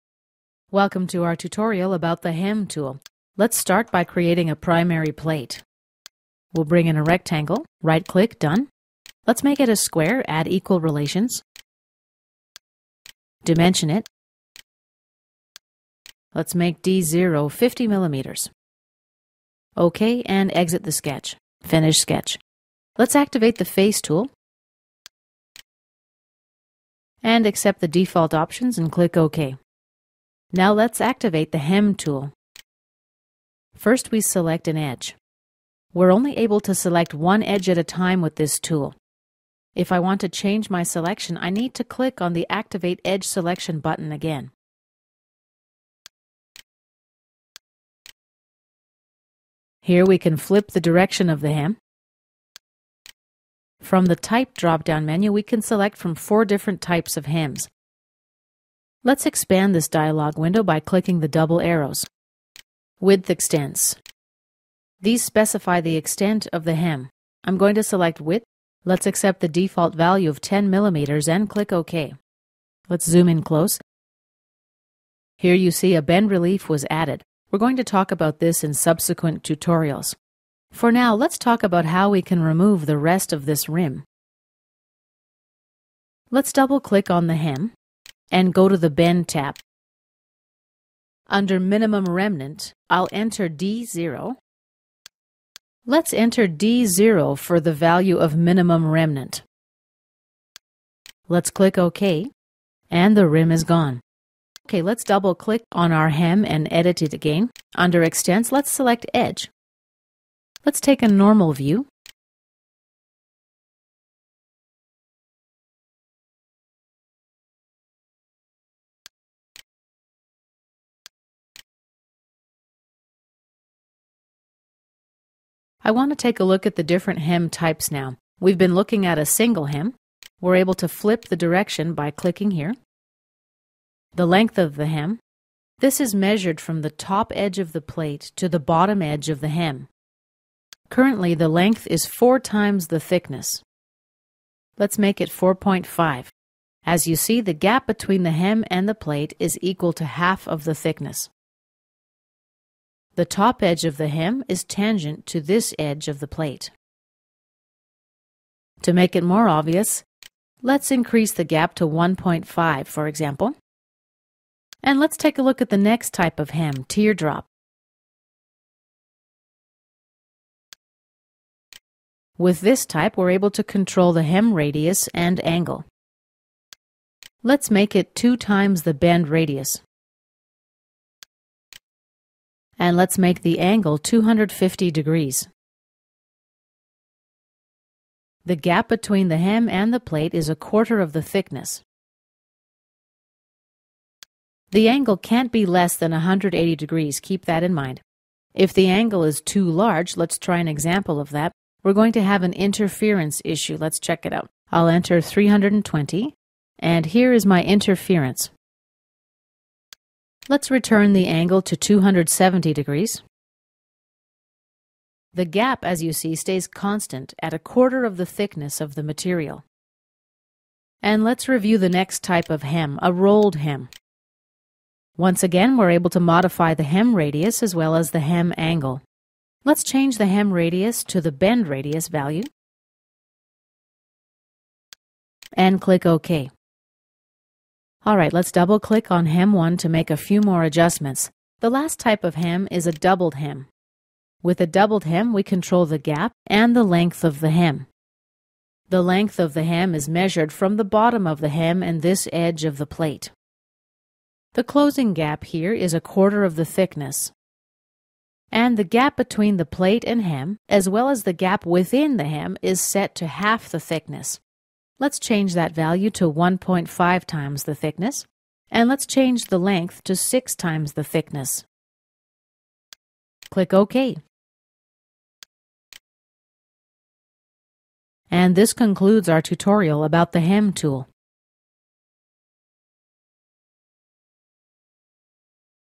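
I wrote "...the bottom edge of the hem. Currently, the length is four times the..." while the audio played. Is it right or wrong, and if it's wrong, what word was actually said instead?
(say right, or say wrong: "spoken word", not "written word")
right.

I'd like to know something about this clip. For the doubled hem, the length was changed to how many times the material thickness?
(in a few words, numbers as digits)
6.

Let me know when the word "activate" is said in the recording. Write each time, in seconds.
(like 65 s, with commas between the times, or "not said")
23 s, 30 s, 42 s.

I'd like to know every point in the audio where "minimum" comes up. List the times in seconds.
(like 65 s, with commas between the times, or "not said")
91 s, 98 s.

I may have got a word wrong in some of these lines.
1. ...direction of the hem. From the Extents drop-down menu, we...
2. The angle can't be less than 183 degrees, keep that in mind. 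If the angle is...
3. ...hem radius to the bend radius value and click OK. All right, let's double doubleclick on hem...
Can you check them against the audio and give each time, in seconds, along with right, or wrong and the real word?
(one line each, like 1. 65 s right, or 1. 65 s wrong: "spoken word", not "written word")
1. 50 s wrong: "Type", not "Extents"
2. 194 s wrong: "180", not "183"
3. 230 s wrong: "click", not "doubleclick".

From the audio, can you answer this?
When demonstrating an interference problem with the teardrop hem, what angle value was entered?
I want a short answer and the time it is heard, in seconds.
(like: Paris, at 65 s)
320, at 205 s.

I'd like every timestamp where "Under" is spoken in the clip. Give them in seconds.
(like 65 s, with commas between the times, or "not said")
91 s, 107 s.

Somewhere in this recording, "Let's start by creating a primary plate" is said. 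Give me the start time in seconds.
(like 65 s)
3 s.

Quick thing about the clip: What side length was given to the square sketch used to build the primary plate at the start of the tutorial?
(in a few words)
50 millimeters.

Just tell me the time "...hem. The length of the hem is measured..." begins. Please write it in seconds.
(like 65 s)
247 s.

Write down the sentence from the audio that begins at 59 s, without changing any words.
Let's expand this dialog window by clicking the double arrows.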